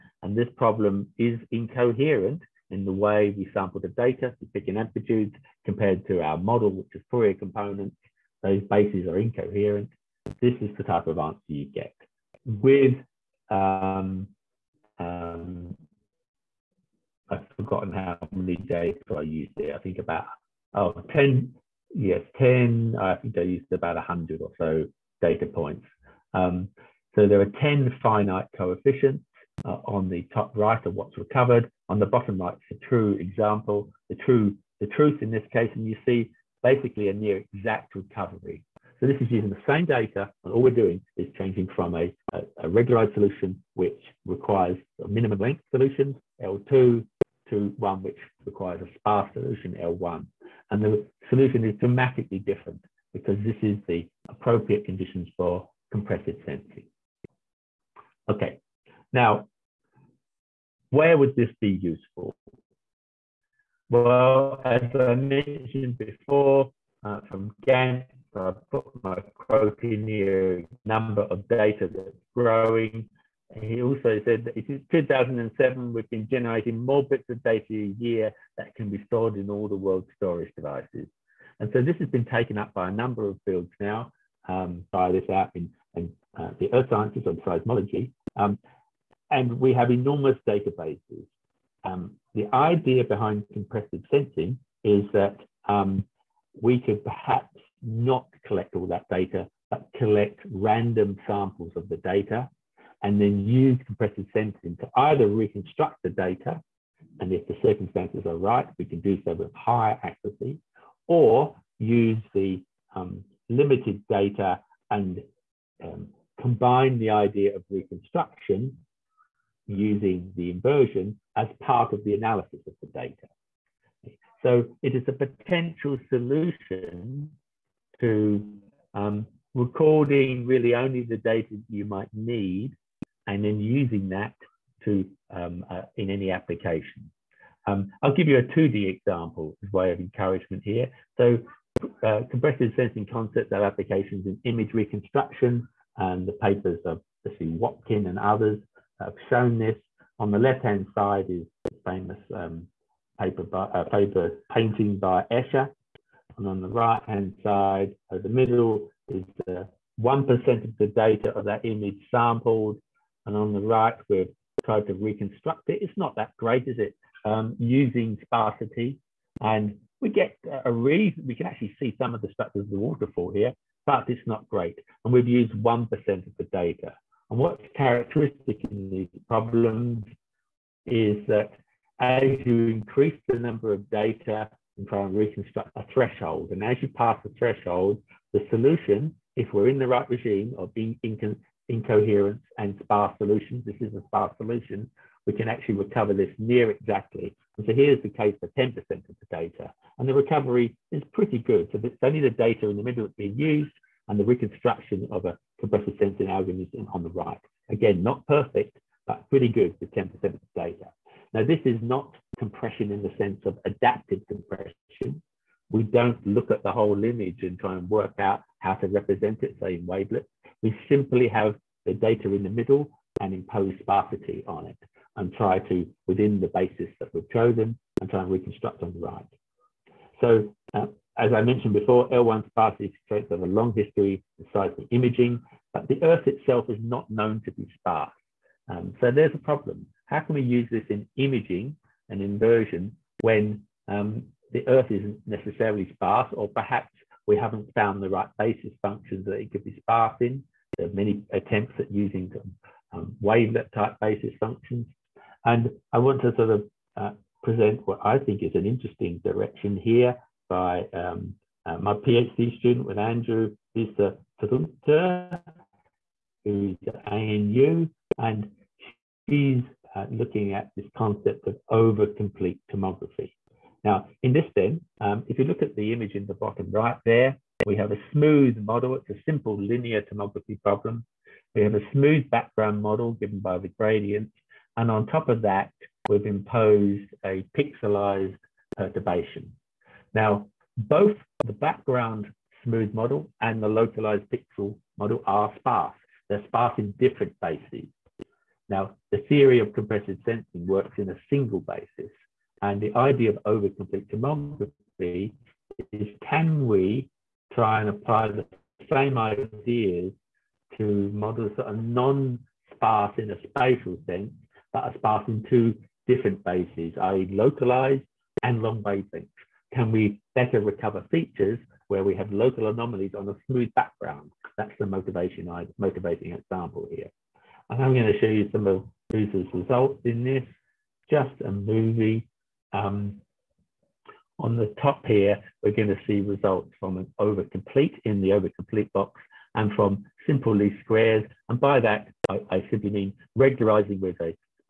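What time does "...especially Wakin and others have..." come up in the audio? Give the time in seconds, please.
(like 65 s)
147 s.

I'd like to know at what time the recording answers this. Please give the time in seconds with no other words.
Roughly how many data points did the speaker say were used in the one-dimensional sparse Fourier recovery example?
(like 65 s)
23 s.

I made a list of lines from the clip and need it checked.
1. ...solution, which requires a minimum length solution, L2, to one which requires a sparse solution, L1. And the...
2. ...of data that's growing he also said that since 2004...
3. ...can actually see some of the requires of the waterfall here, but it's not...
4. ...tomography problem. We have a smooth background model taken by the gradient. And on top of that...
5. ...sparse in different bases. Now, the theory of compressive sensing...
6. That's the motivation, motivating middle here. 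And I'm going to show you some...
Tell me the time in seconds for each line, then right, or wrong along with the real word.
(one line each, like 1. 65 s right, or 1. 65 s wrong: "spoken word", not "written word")
1. 43 s right
2. 71 s wrong: "2007", not "2004"
3. 171 s wrong: "structures", not "requires"
4. 280 s wrong: "given", not "taken"
5. 296 s right
6. 324 s wrong: "example", not "middle".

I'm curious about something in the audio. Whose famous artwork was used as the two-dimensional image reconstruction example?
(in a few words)
Escher.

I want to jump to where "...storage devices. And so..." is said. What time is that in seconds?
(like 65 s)
80 s.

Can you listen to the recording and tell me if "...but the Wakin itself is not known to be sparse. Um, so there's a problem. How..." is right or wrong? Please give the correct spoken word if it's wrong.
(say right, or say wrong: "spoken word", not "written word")
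wrong: "Earth", not "Wakin".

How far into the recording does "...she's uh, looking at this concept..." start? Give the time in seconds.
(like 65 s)
269 s.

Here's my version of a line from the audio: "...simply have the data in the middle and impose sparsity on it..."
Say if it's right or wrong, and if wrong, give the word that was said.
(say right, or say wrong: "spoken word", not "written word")
right.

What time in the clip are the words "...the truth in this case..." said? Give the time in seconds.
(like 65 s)
34 s.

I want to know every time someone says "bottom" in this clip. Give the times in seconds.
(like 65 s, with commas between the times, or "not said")
32 s, 276 s.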